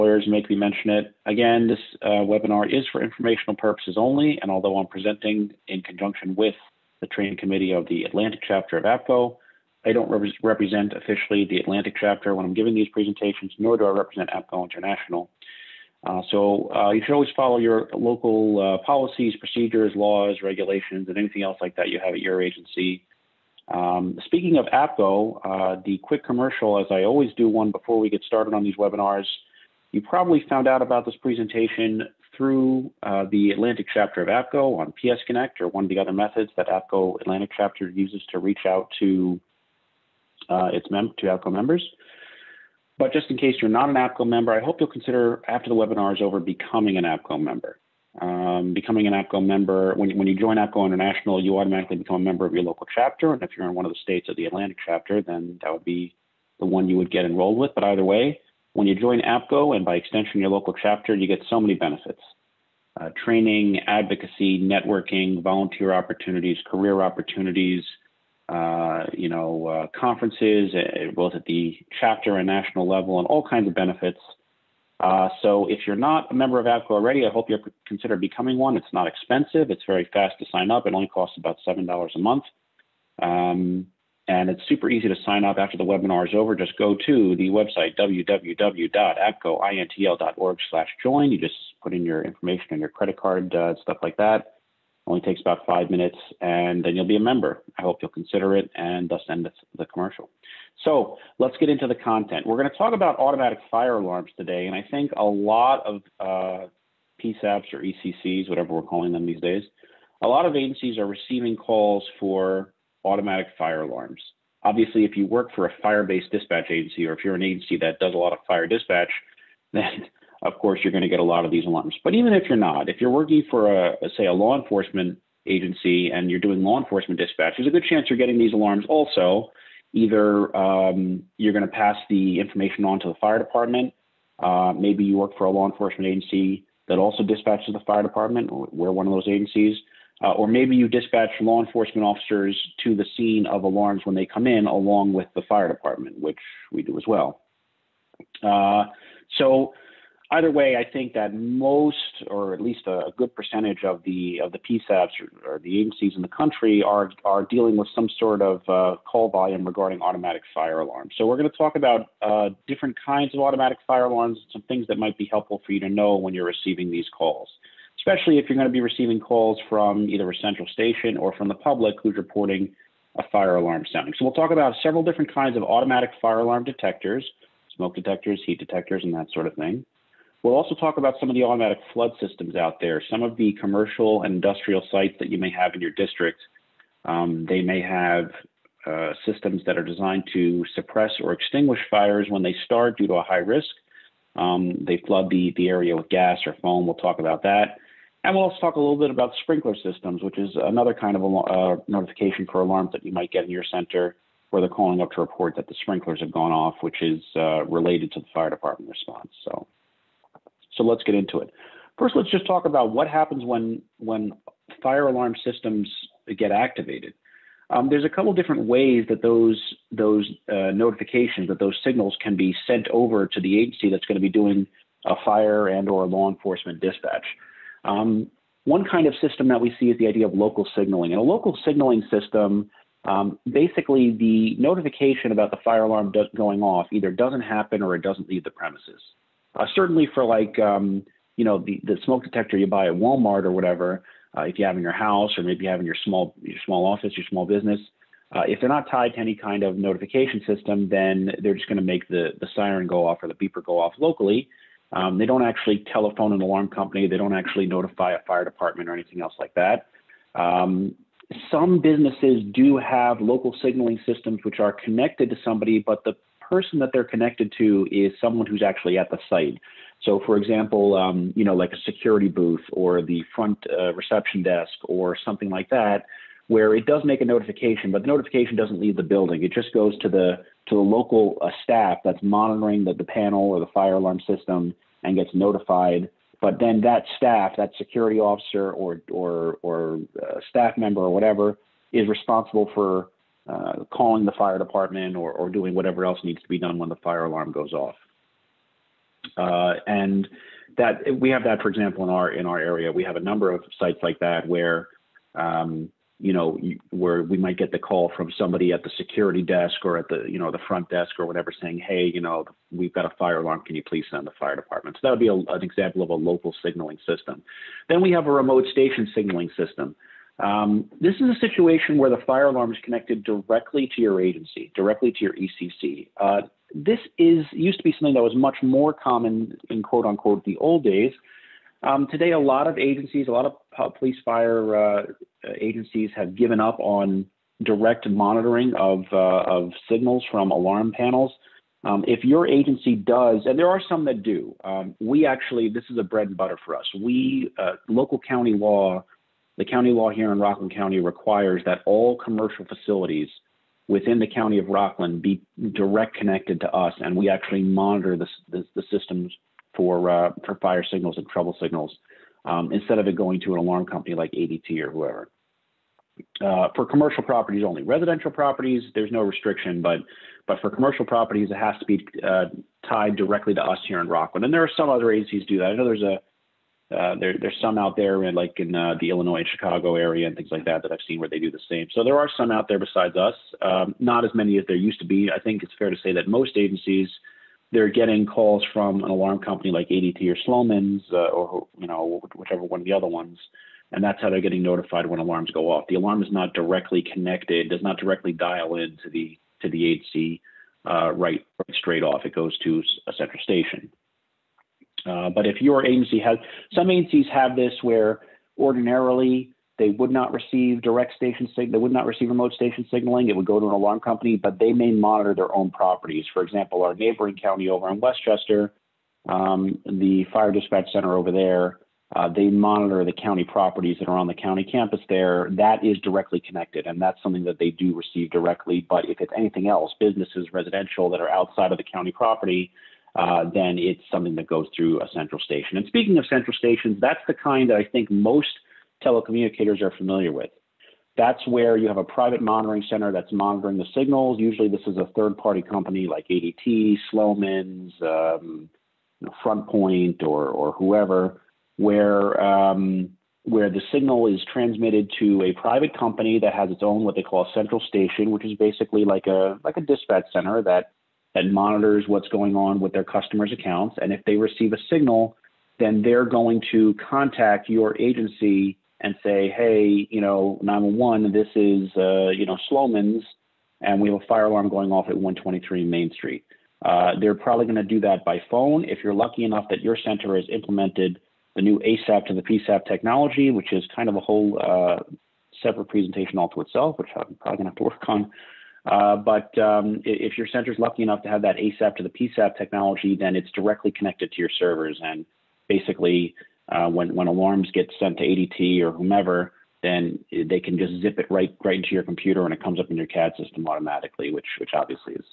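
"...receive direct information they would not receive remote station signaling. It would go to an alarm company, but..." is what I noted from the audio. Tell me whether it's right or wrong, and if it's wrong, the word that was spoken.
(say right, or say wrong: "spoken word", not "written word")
wrong: "station", not "information".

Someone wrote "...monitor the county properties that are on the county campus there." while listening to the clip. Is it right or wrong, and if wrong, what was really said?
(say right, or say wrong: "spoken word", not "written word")
right.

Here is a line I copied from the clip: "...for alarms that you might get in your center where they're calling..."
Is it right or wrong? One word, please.
right.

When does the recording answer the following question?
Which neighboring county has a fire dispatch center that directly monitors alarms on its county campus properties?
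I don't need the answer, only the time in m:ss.
6:57.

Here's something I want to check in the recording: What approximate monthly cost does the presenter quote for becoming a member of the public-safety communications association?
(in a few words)
$7.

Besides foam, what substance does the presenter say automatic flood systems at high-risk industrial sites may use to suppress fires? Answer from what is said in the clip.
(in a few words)
gas.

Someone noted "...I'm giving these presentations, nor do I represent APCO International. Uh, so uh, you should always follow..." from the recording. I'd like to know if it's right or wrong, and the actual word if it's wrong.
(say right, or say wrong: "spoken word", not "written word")
right.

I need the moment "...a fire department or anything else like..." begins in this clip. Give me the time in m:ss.
4:18.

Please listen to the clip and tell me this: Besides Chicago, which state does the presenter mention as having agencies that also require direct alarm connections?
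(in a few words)
Illinois.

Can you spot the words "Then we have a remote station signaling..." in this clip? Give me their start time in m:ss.
5:17.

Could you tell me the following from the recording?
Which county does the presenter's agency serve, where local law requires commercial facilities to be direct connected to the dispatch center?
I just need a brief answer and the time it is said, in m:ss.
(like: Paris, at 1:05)
Rockland County, at 5:50.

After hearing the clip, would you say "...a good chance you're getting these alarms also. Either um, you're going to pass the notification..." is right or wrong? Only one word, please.
wrong.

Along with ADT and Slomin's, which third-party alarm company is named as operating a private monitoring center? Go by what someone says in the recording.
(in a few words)
FrontPoint.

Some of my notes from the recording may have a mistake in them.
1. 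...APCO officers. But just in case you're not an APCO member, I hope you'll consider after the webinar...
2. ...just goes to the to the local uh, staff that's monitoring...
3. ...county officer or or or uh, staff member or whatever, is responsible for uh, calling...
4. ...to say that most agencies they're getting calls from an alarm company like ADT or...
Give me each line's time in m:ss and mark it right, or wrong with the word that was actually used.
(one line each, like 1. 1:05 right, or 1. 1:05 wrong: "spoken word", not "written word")
1. 0:41 wrong: "members", not "officers"
2. 4:39 right
3. 4:47 wrong: "security", not "county"
4. 6:25 right.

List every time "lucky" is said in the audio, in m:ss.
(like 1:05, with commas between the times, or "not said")
7:59, 8:10.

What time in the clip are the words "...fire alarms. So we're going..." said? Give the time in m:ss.
2:40.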